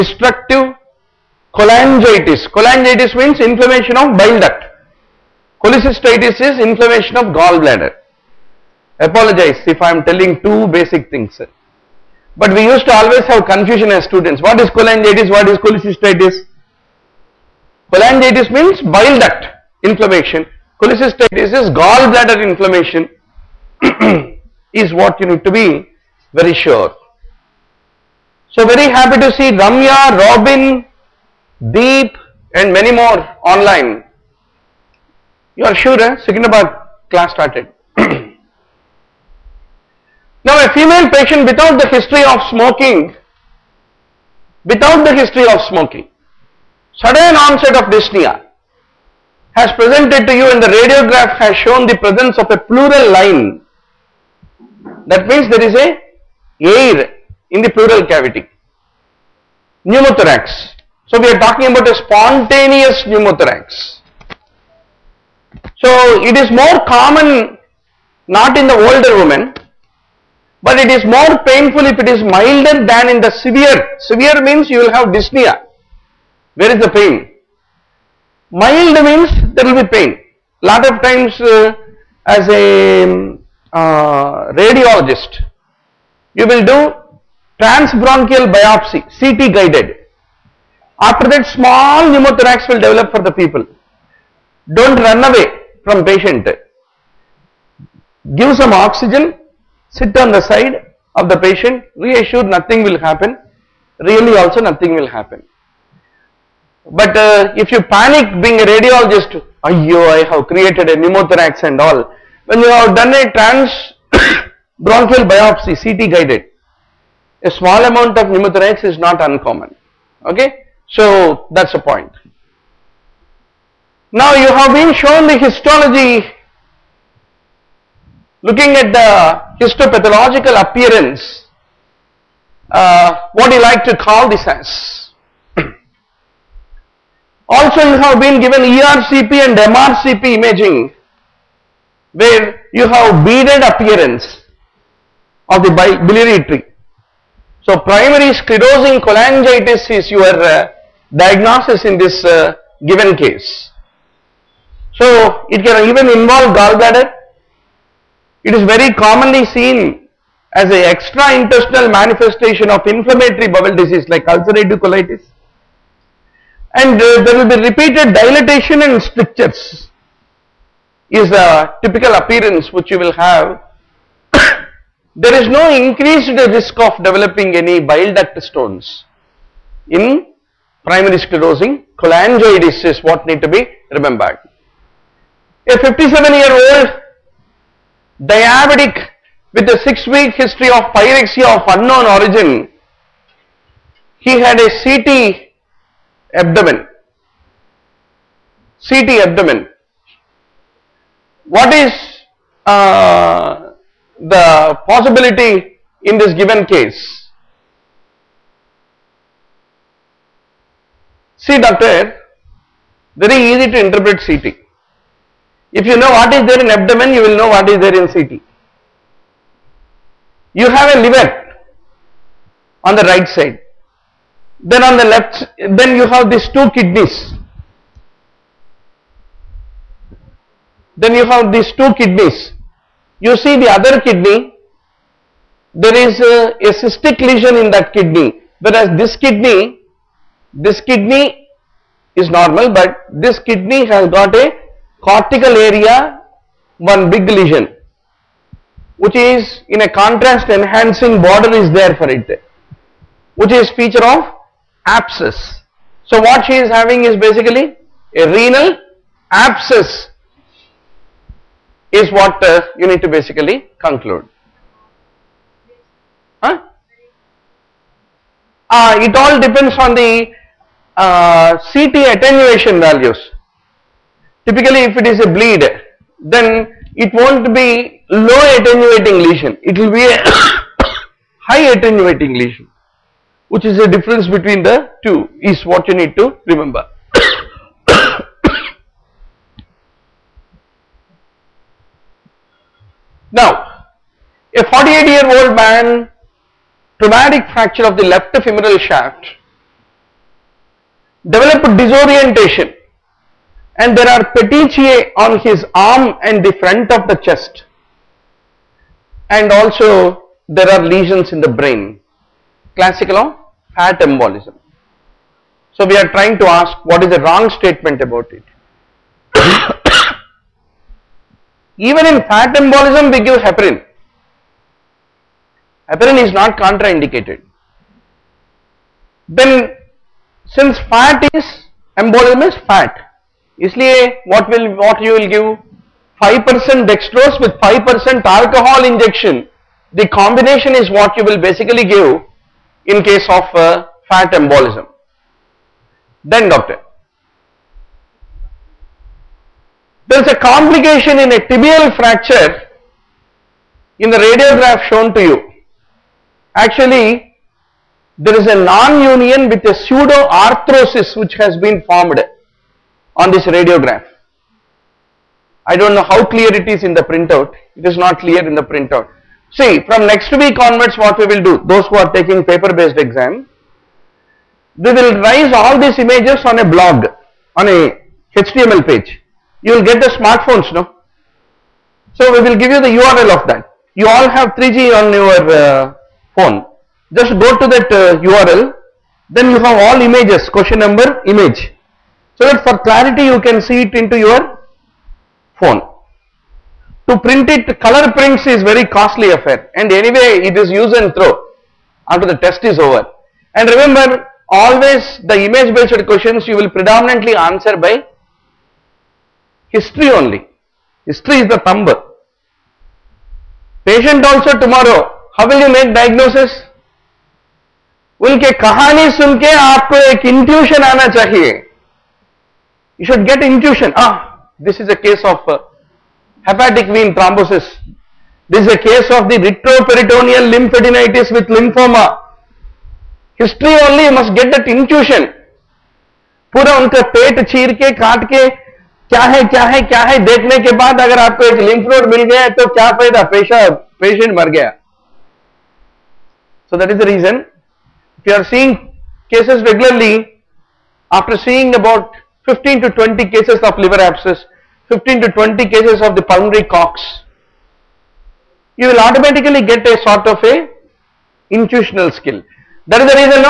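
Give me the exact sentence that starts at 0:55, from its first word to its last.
That means there is a air in the pleural cavity.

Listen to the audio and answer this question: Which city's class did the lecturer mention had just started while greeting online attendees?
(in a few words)
Secunderabad.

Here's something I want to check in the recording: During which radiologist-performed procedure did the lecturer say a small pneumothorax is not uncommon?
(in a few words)
Transbronchial biopsy.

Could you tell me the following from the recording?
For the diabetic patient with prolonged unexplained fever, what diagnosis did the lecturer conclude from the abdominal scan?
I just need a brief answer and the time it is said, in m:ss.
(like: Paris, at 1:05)
Renal abscess, at 4:18.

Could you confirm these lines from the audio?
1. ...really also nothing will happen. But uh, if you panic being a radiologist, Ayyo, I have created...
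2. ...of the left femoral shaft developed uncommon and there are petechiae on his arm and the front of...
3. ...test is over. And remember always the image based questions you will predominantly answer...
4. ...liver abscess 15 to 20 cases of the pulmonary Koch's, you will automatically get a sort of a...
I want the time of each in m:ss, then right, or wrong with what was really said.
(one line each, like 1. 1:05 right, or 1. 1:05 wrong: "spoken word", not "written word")
1. 1:44 right
2. 4:57 wrong: "disorientation", not "uncommon"
3. 6:42 right
4. 7:33 right.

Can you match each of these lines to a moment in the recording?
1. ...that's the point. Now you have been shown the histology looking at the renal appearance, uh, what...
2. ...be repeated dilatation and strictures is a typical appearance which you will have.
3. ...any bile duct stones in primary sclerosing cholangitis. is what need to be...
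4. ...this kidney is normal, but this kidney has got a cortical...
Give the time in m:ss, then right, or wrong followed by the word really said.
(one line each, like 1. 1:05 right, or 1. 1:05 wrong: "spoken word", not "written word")
1. 2:01 wrong: "histopathological", not "renal"
2. 2:47 right
3. 2:57 right
4. 4:00 right.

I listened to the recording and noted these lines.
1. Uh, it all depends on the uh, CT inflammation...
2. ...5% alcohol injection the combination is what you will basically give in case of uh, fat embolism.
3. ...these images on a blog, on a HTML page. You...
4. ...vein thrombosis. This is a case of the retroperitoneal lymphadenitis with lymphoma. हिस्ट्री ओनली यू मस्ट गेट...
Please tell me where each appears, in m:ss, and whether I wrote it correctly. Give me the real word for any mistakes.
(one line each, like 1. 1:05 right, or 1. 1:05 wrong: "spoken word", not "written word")
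1. 4:28 wrong: "attenuation", not "inflammation"
2. 5:37 right
3. 6:15 right
4. 7:06 right.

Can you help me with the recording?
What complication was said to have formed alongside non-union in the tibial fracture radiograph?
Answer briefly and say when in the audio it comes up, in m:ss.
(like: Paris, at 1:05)
Pseudo-arthrosis, at 5:59.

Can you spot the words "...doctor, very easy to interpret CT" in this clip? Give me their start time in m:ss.
3:31.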